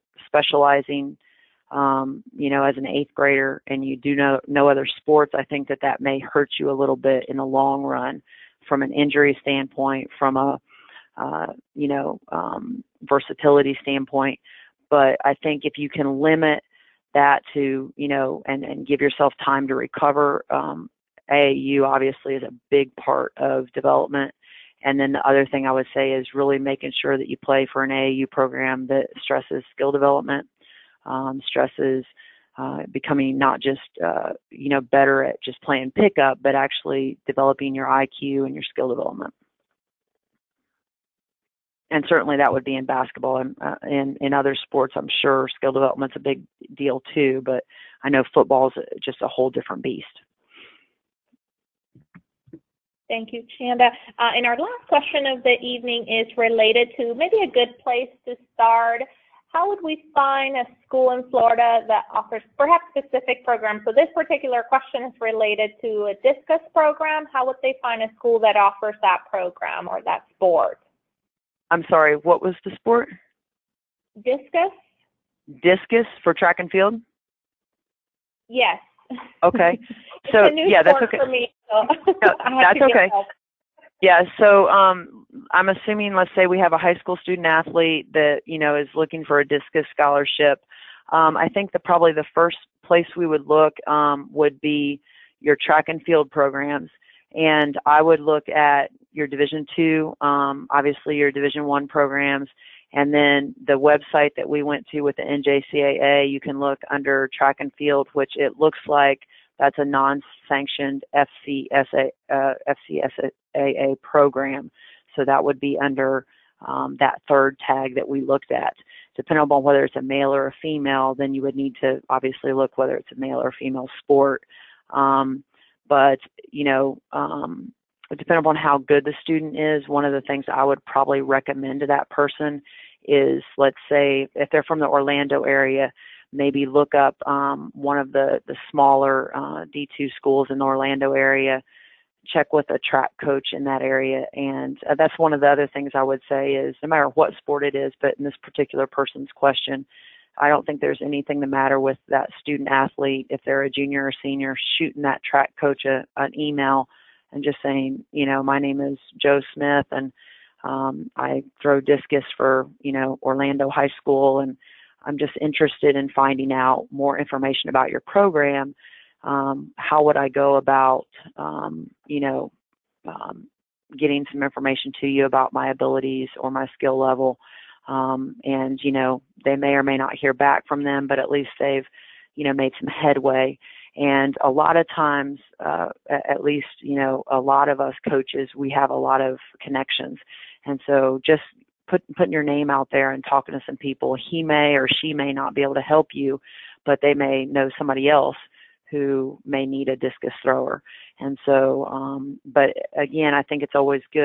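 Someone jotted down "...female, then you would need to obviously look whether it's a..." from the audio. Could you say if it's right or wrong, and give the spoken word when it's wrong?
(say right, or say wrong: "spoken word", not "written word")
right.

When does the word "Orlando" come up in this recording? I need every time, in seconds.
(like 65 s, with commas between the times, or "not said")
134 s, 140 s, 163 s.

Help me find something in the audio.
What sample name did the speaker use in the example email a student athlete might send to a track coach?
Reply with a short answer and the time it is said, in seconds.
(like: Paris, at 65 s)
Joe Smith, at 159 s.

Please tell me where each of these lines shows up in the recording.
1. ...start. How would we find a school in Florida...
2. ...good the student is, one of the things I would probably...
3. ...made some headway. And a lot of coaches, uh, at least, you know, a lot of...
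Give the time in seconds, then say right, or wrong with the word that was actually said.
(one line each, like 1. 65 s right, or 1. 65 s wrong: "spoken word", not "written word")
1. 58 s right
2. 128 s right
3. 182 s wrong: "times", not "coaches".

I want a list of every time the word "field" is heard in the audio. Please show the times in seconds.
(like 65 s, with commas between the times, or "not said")
76 s, 96 s, 107 s.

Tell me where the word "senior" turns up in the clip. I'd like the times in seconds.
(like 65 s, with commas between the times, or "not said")
154 s.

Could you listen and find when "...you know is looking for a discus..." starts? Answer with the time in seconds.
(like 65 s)
88 s.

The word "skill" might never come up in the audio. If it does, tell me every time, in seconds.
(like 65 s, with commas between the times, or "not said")
29 s, 38 s, 45 s, 176 s.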